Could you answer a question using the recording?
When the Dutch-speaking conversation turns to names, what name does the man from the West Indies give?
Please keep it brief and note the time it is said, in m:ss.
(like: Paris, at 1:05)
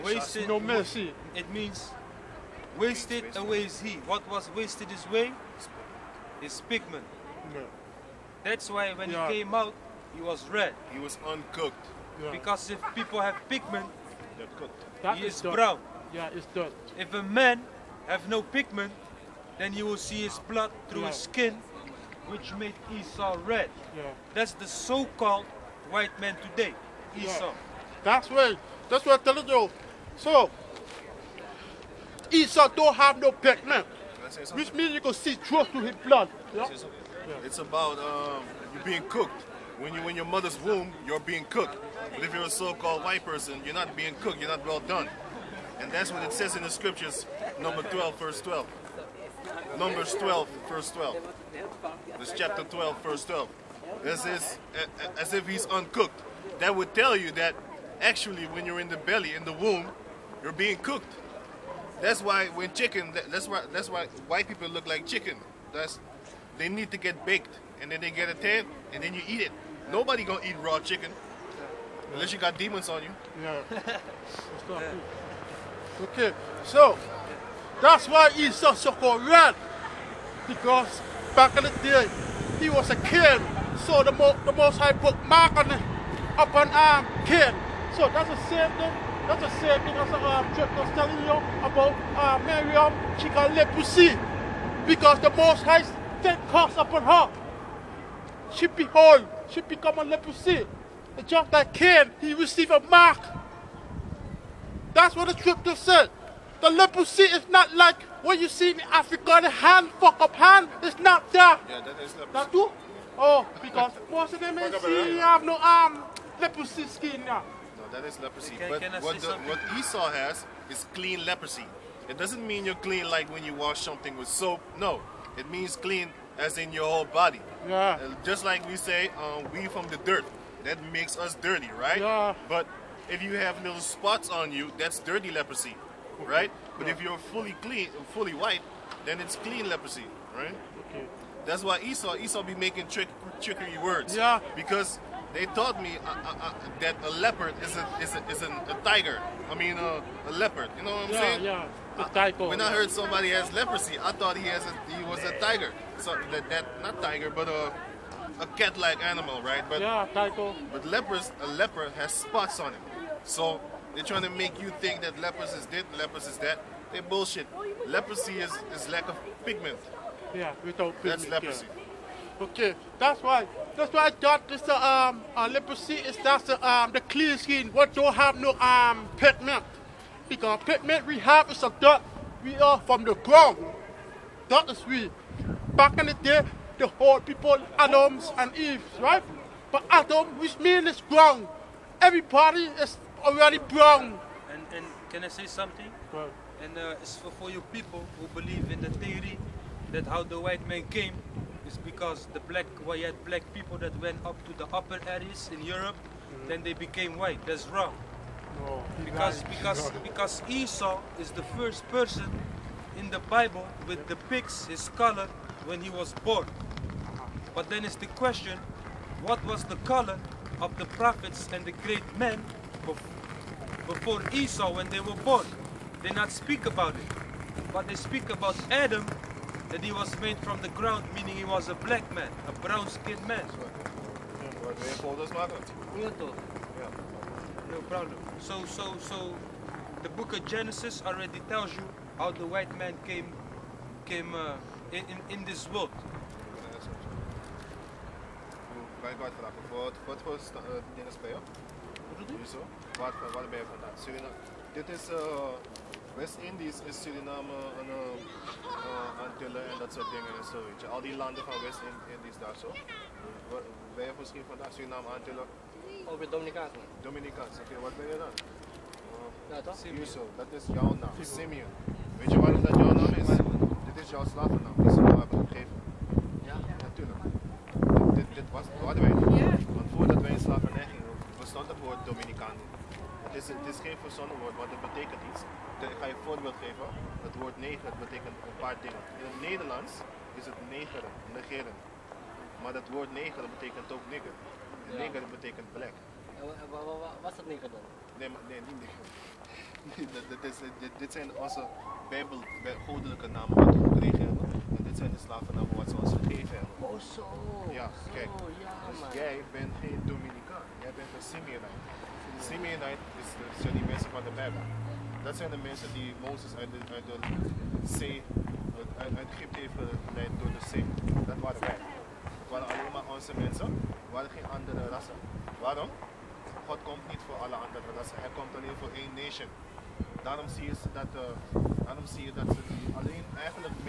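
Simeon, at 4:31.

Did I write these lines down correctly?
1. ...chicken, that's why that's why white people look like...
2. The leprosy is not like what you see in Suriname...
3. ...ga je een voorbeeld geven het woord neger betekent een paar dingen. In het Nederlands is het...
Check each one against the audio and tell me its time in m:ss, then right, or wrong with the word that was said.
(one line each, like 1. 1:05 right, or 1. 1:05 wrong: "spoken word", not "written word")
1. 1:02 right
2. 1:46 wrong: "Africa", not "Suriname"
3. 4:45 right.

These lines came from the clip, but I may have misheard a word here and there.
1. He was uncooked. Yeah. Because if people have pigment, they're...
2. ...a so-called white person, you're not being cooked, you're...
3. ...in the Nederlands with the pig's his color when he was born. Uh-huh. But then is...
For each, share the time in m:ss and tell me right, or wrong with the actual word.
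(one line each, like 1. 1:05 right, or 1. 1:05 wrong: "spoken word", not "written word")
1. 0:10 right
2. 0:42 right
3. 3:32 wrong: "Bible", not "Nederlands".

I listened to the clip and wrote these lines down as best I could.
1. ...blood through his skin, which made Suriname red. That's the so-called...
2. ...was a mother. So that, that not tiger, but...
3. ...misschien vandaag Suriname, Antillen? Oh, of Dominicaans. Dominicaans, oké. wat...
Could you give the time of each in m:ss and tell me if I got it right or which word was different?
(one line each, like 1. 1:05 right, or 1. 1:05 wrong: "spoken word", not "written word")
1. 0:20 wrong: "Esau", not "Suriname"
2. 2:35 wrong: "tiger", not "mother"
3. 4:24 right.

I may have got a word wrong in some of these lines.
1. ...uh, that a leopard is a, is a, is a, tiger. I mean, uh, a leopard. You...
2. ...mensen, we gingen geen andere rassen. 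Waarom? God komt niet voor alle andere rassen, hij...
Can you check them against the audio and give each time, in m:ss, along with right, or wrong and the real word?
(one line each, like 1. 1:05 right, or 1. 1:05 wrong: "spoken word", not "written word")
1. 2:26 right
2. 5:23 wrong: "waren", not "gingen".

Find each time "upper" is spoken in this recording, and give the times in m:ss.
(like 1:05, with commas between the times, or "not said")
1:26, 3:24.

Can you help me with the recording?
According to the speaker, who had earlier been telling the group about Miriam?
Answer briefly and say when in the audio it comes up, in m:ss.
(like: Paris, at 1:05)
Drake, at 1:30.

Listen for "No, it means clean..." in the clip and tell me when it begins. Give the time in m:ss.
2:04.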